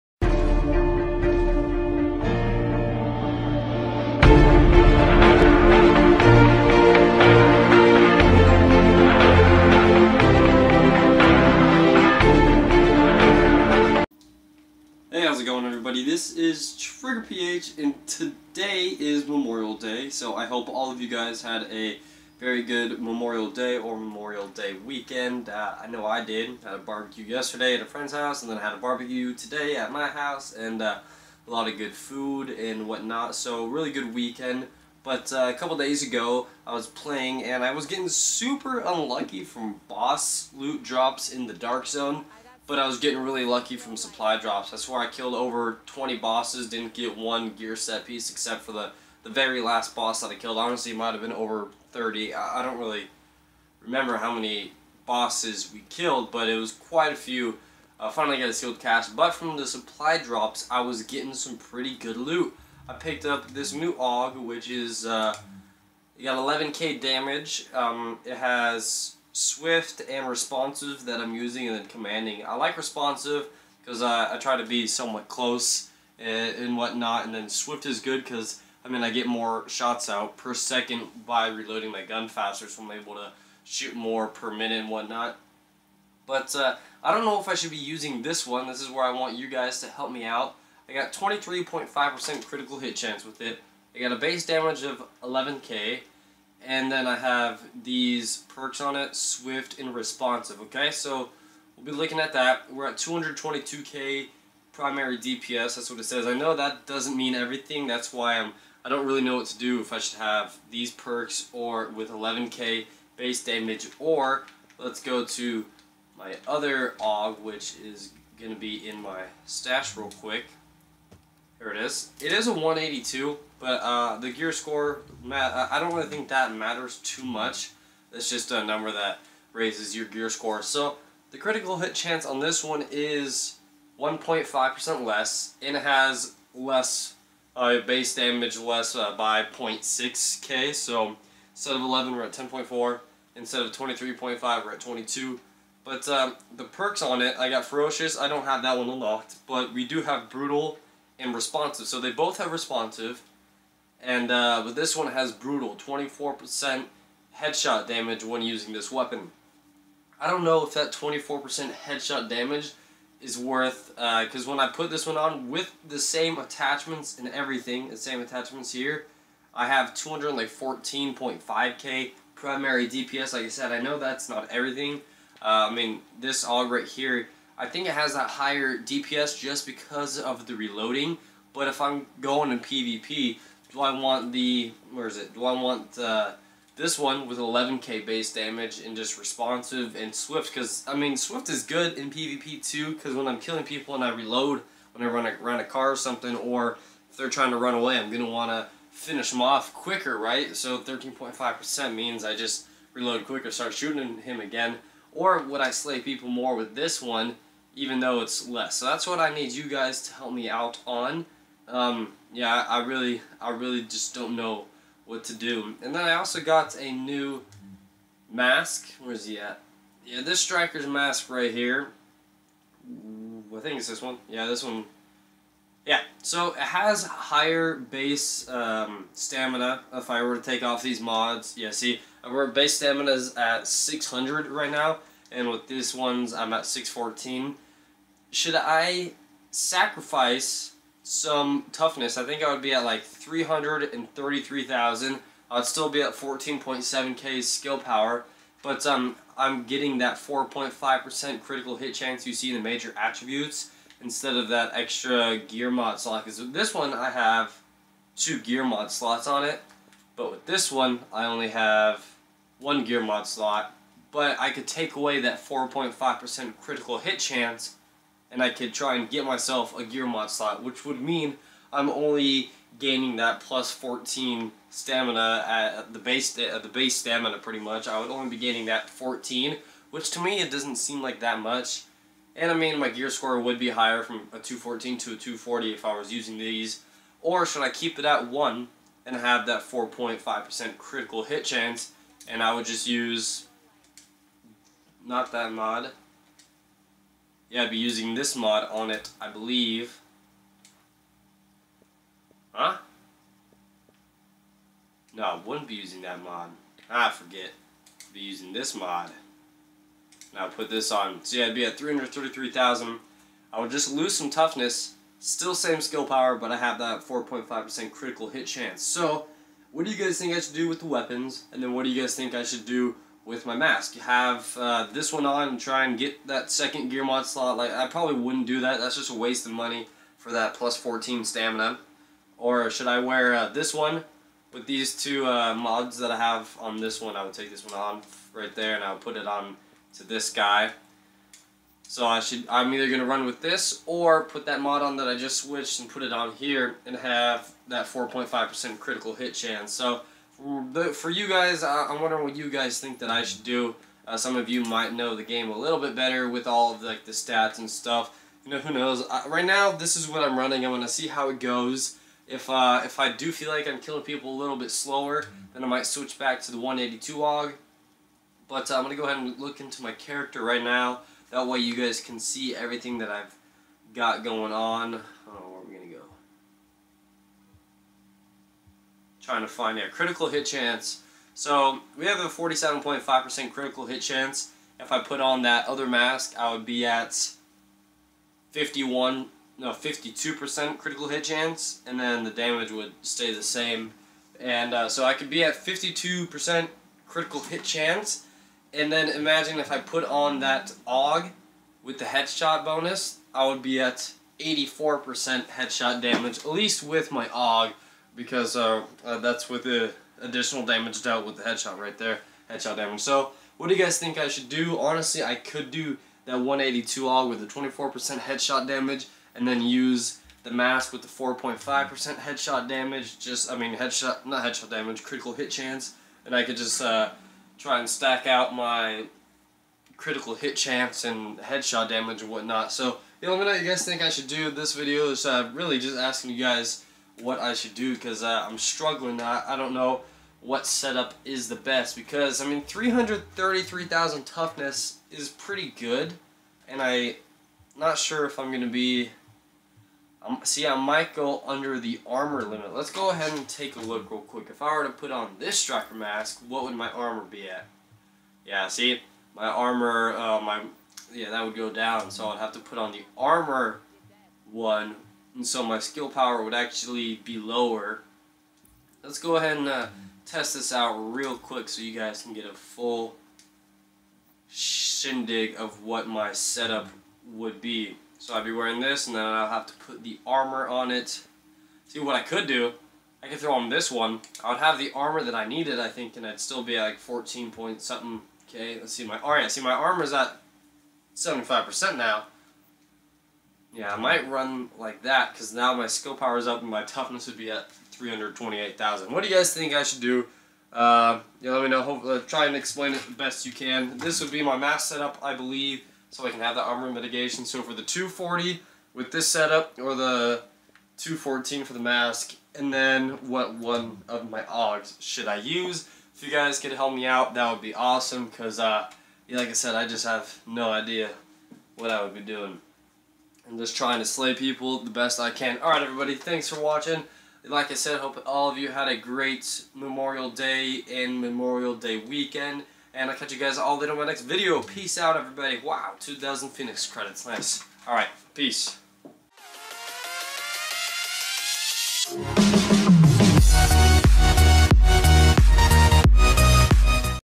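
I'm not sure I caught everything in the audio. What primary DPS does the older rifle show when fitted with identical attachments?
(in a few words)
214.5k.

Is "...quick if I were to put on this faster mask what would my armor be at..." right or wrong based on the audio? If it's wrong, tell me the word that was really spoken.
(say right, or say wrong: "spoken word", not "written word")
wrong: "striker", not "faster".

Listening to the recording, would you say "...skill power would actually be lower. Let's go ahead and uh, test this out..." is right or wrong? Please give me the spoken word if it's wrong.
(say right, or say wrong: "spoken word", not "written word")
right.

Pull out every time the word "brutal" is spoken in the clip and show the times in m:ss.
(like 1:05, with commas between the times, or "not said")
2:30, 2:35.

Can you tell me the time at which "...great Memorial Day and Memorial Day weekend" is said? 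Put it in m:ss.
8:48.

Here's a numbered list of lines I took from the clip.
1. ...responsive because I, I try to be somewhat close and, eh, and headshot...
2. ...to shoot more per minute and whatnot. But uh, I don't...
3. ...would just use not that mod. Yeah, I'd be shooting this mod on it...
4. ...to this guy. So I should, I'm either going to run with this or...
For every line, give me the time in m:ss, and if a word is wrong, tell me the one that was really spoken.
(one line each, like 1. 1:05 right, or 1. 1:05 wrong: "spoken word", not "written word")
1. 1:12 wrong: "whatnot", not "headshot"
2. 1:23 right
3. 4:52 wrong: "using", not "shooting"
4. 5:39 right.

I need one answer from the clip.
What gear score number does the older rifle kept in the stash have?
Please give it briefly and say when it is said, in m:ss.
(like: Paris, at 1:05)
182, at 2:02.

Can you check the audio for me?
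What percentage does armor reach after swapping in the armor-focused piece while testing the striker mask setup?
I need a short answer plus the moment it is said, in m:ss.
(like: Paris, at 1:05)
75%, at 8:09.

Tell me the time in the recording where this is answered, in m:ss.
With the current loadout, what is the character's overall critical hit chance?
6:22.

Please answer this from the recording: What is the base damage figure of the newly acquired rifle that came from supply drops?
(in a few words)
11k.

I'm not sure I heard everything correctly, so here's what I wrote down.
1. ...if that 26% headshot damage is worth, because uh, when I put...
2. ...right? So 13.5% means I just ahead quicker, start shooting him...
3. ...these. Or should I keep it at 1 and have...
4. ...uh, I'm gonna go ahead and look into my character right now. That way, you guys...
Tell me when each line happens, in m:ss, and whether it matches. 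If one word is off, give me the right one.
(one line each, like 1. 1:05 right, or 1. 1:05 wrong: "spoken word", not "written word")
1. 2:40 wrong: "24", not "26"
2. 3:20 wrong: "reload", not "ahead"
3. 4:46 right
4. 6:08 right.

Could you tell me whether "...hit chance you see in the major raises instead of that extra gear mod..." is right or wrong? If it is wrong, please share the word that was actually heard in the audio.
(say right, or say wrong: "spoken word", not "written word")
wrong: "attributes", not "raises".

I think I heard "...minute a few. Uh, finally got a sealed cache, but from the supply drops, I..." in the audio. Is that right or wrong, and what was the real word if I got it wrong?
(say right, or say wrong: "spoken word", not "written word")
wrong: "quite", not "minute".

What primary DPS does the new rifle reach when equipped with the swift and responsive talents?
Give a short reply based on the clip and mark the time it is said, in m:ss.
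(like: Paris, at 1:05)
222k, at 1:42.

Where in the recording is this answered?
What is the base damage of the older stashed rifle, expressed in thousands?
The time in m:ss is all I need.
2:22.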